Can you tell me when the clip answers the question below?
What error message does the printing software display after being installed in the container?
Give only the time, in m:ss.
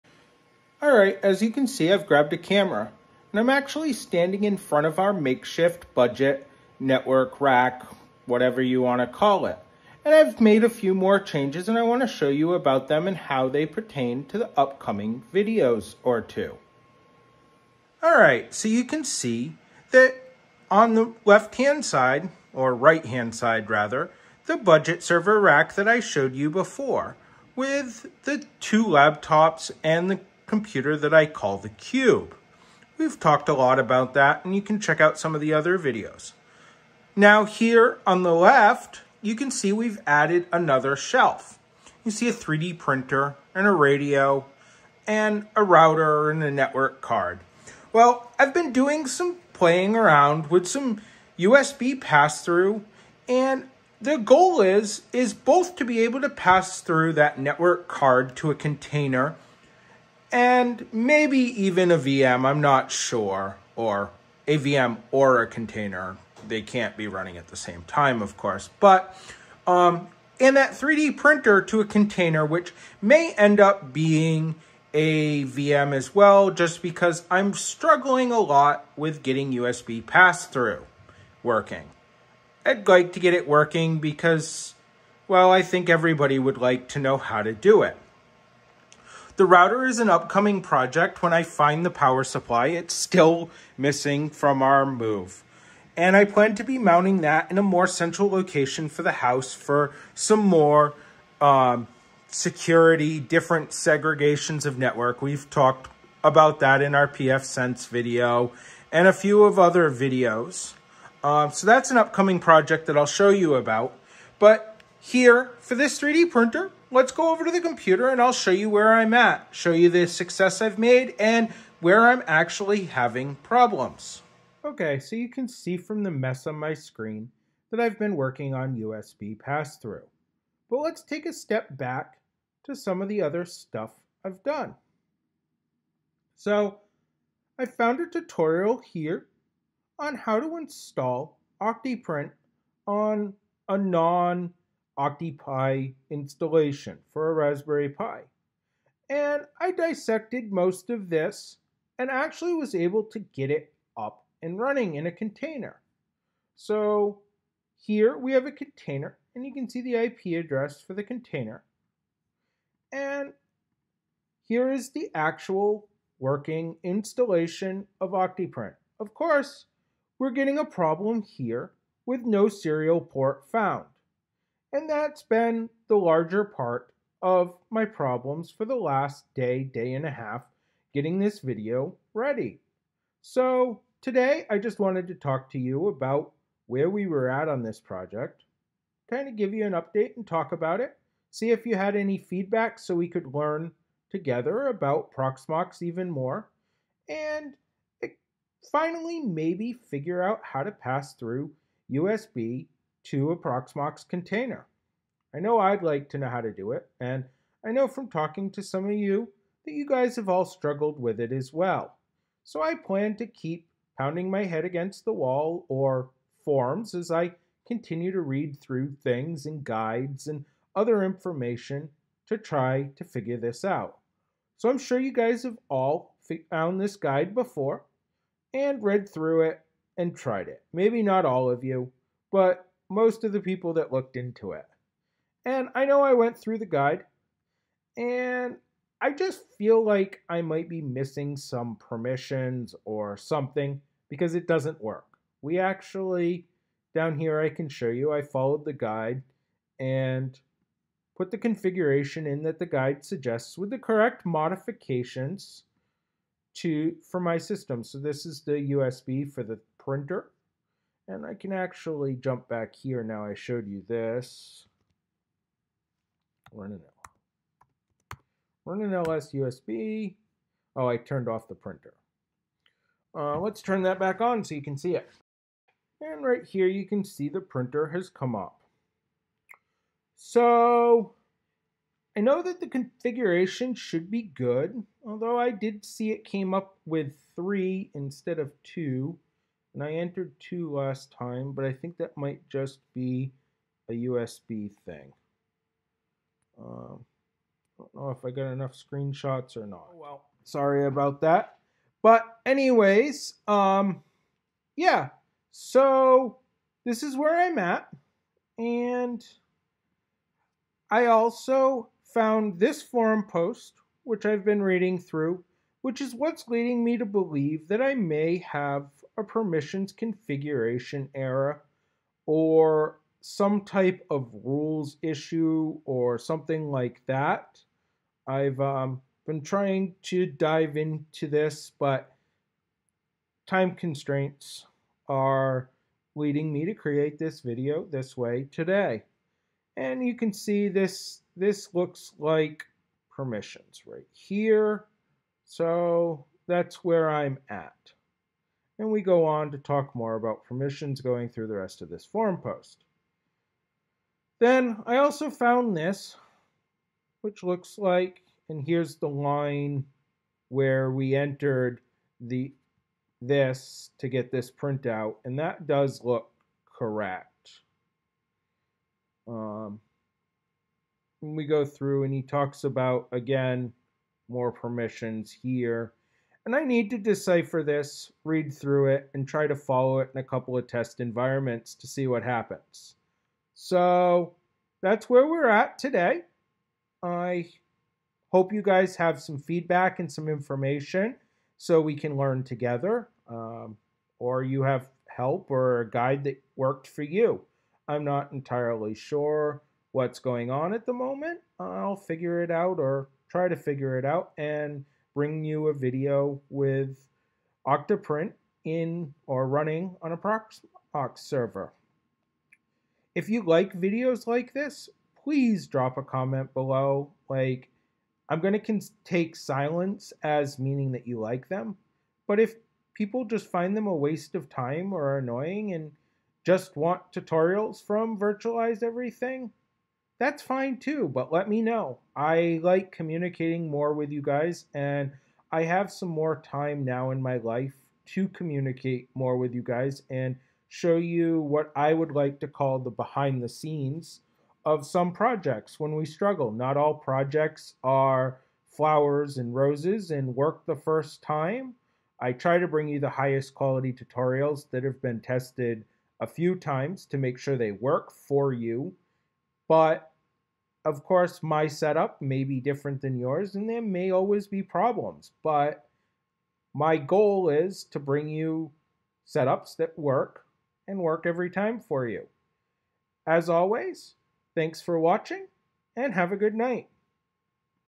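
2:52.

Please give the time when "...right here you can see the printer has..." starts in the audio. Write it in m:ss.
4:36.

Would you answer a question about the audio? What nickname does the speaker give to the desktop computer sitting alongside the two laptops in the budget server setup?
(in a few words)
The Cube.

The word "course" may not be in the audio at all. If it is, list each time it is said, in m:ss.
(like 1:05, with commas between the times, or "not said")
1:08, 2:49, 7:41.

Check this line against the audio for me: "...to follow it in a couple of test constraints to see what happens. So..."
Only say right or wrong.
wrong.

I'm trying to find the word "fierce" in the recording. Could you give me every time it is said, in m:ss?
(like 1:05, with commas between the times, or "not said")
not said.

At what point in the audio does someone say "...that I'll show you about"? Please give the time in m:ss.
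1:52.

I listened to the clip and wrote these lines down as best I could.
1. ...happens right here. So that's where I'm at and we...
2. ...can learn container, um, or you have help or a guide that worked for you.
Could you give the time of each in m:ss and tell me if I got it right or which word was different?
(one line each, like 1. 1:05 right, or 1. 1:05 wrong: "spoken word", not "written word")
1. 5:43 wrong: "permissions", not "happens"
2. 6:31 wrong: "together", not "container".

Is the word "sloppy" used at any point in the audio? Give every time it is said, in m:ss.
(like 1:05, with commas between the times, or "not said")
not said.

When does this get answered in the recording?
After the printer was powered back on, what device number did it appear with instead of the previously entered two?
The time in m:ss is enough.
4:47.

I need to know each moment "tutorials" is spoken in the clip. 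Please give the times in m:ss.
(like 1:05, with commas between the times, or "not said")
2:18, 7:07, 7:33.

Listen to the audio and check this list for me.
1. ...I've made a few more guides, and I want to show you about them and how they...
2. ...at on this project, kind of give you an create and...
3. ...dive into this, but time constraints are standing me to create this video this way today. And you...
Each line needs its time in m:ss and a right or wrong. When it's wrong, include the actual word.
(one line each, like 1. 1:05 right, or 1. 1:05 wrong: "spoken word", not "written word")
1. 0:10 wrong: "changes", not "guides"
2. 3:07 wrong: "update", not "create"
3. 5:30 wrong: "leading", not "standing".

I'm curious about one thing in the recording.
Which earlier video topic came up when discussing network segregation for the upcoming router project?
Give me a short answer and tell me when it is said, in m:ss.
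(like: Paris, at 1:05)
pfSense, at 1:47.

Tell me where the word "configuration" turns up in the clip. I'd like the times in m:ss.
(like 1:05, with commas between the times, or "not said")
4:11, 4:42, 5:19.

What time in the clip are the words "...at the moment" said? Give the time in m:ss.
6:40.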